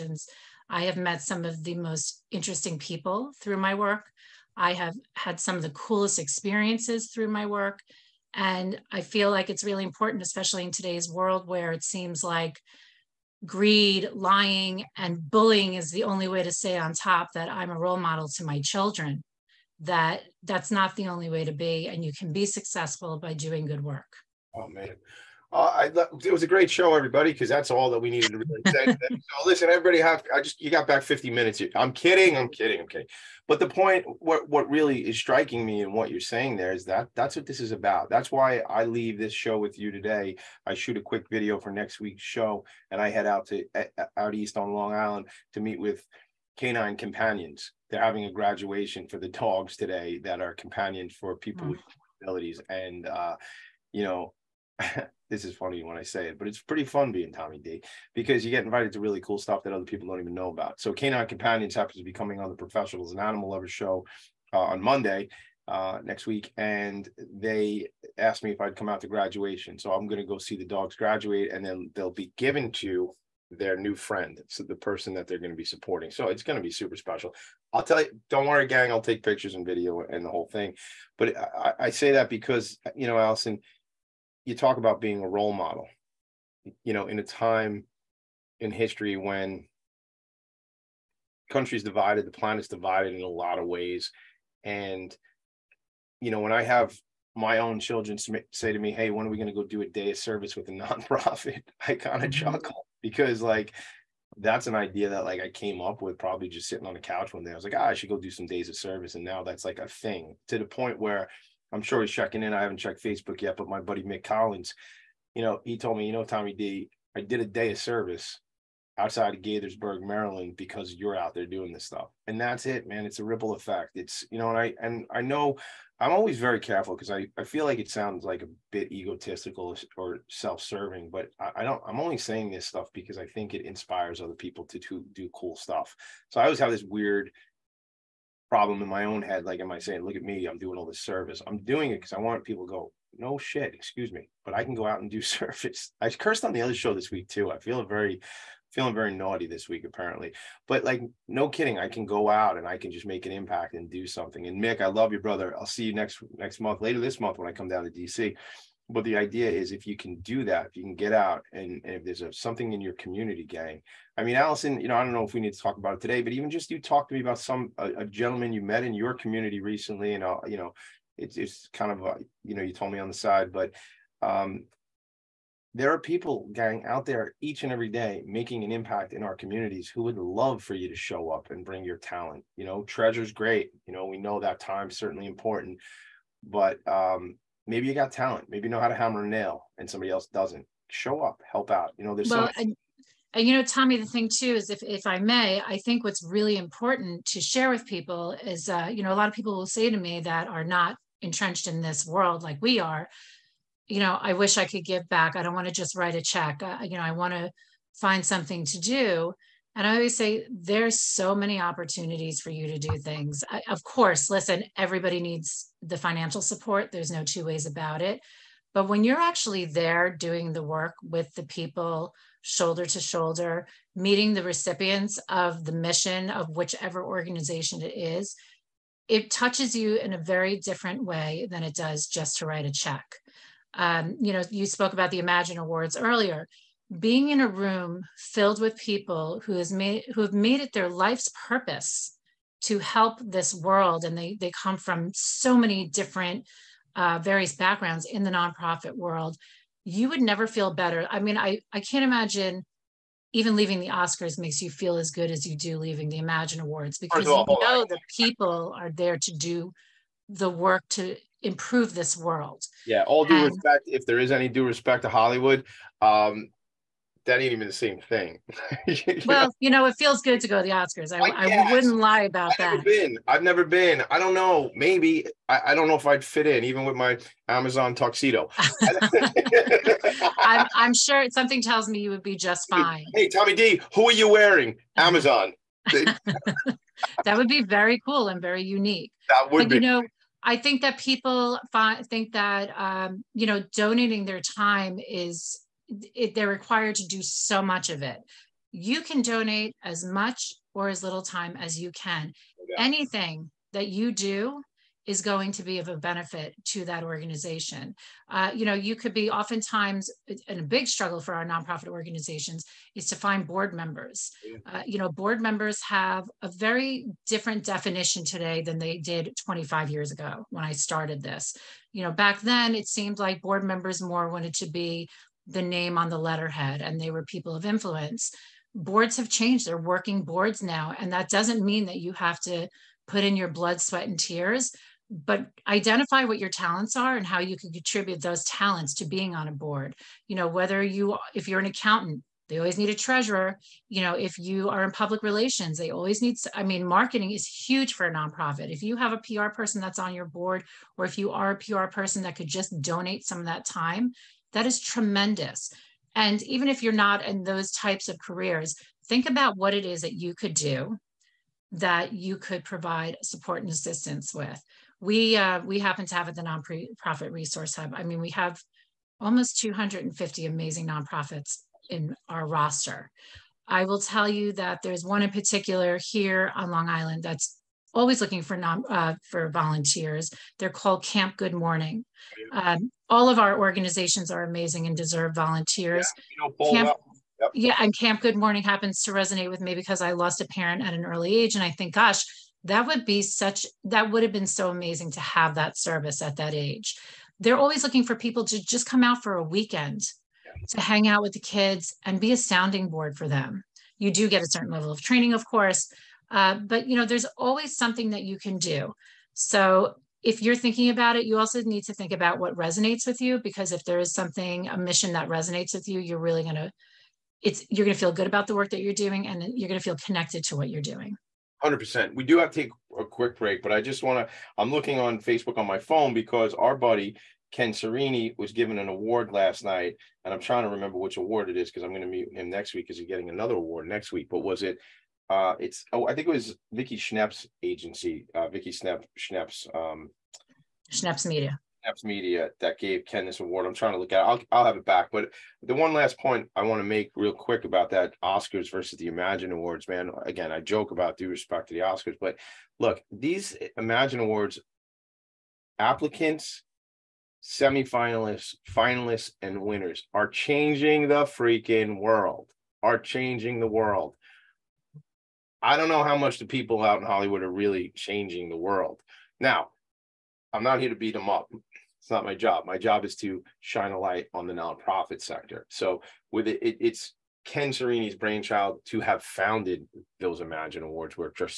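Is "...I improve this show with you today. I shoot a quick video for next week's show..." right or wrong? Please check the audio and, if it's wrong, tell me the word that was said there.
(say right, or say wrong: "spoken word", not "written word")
wrong: "leave", not "improve".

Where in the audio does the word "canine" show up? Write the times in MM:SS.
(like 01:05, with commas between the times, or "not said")
00:46, 01:00.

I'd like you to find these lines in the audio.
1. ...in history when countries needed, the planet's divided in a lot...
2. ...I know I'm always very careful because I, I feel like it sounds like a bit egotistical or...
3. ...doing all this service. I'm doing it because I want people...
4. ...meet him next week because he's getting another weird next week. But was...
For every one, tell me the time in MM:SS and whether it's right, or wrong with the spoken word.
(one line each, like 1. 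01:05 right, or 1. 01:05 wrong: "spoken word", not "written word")
1. 01:28 wrong: "divided", not "needed"
2. 02:05 right
3. 02:20 right
4. 07:12 wrong: "award", not "weird".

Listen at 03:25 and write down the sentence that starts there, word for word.
I don't want to just write a check.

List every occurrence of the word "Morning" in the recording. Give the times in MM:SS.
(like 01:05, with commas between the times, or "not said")
06:21, 06:28.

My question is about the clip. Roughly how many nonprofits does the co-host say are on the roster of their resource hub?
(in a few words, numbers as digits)
250.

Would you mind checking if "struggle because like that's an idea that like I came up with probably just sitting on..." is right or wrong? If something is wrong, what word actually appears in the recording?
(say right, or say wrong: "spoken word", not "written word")
wrong: "chuckle", not "struggle".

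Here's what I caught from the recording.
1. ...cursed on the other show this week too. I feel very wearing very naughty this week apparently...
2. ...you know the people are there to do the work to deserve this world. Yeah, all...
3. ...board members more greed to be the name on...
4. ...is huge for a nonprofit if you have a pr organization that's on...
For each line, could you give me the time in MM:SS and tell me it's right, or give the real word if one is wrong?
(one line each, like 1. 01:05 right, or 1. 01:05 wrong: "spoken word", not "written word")
1. 02:26 wrong: "feeling", not "wearing"
2. 04:17 wrong: "improve", not "deserve"
3. 05:23 wrong: "wanted", not "greed"
4. 05:47 wrong: "person", not "organization".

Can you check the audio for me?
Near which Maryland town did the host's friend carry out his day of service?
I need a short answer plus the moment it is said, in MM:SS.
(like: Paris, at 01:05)
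Gaithersburg, at 01:59.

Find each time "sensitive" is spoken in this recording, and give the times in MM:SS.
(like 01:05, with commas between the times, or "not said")
not said.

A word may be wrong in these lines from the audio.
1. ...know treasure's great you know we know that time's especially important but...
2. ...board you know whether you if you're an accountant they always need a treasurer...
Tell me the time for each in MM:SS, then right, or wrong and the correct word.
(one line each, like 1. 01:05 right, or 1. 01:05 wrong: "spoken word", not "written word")
1. 03:02 wrong: "certainly", not "especially"
2. 05:39 right.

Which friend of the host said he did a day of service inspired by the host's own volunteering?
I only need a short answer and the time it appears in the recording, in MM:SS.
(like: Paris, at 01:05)
Mick Collins, at 01:54.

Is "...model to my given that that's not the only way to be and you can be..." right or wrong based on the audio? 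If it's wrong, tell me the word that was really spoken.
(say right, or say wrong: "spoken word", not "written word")
wrong: "children", not "given".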